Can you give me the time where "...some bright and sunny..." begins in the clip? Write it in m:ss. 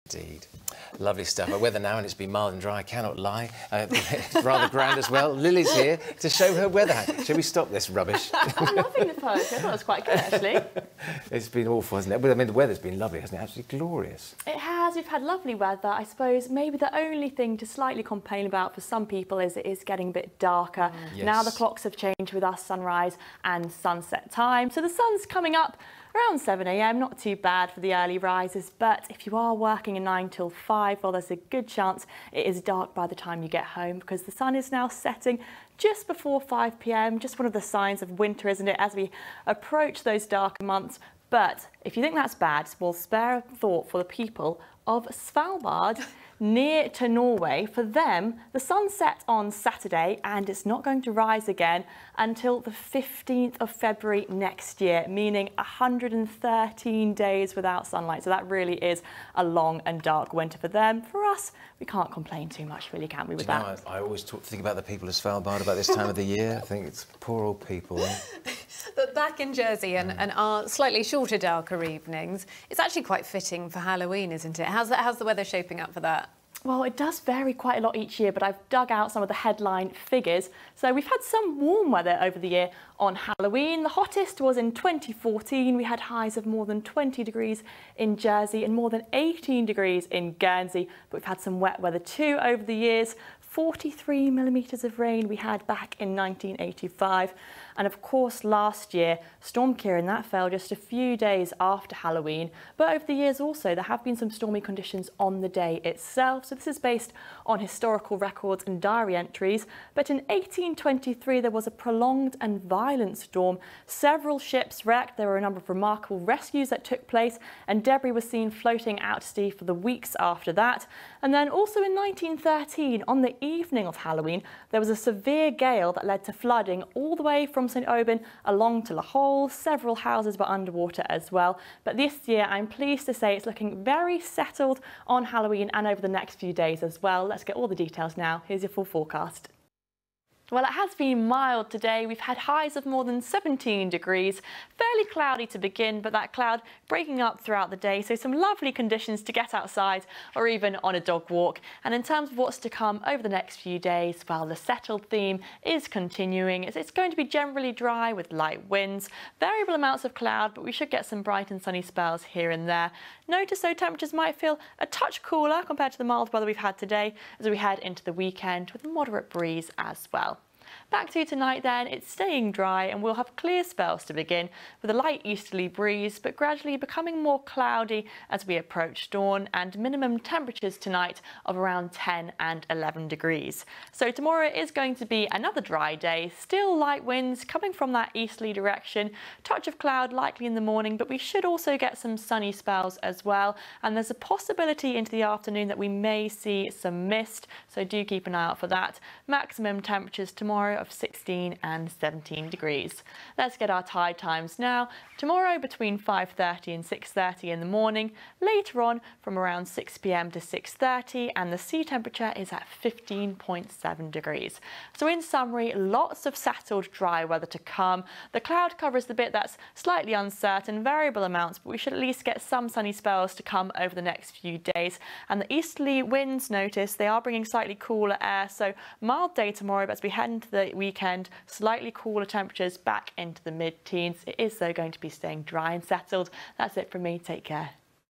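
2:41.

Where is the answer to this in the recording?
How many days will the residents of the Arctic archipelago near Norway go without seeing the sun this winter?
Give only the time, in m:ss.
0:55.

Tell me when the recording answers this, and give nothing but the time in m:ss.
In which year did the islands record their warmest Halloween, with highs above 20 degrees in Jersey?
1:24.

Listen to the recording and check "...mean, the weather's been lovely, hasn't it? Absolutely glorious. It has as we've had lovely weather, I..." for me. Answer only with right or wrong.
right.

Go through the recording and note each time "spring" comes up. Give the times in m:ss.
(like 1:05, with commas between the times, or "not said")
not said.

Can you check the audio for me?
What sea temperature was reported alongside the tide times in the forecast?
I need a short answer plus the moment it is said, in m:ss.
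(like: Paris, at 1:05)
15.7 degrees, at 3:32.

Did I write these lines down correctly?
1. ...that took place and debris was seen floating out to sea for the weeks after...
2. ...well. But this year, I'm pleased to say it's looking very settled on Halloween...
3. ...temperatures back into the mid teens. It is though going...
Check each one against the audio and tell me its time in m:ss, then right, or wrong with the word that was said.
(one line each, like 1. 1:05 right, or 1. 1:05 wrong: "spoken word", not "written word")
1. 1:56 right
2. 2:11 right
3. 3:52 right.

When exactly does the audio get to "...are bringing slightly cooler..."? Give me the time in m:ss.
3:47.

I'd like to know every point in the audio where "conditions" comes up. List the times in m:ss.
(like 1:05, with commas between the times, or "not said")
1:44, 2:28.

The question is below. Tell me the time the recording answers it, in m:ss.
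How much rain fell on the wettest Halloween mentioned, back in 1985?
1:33.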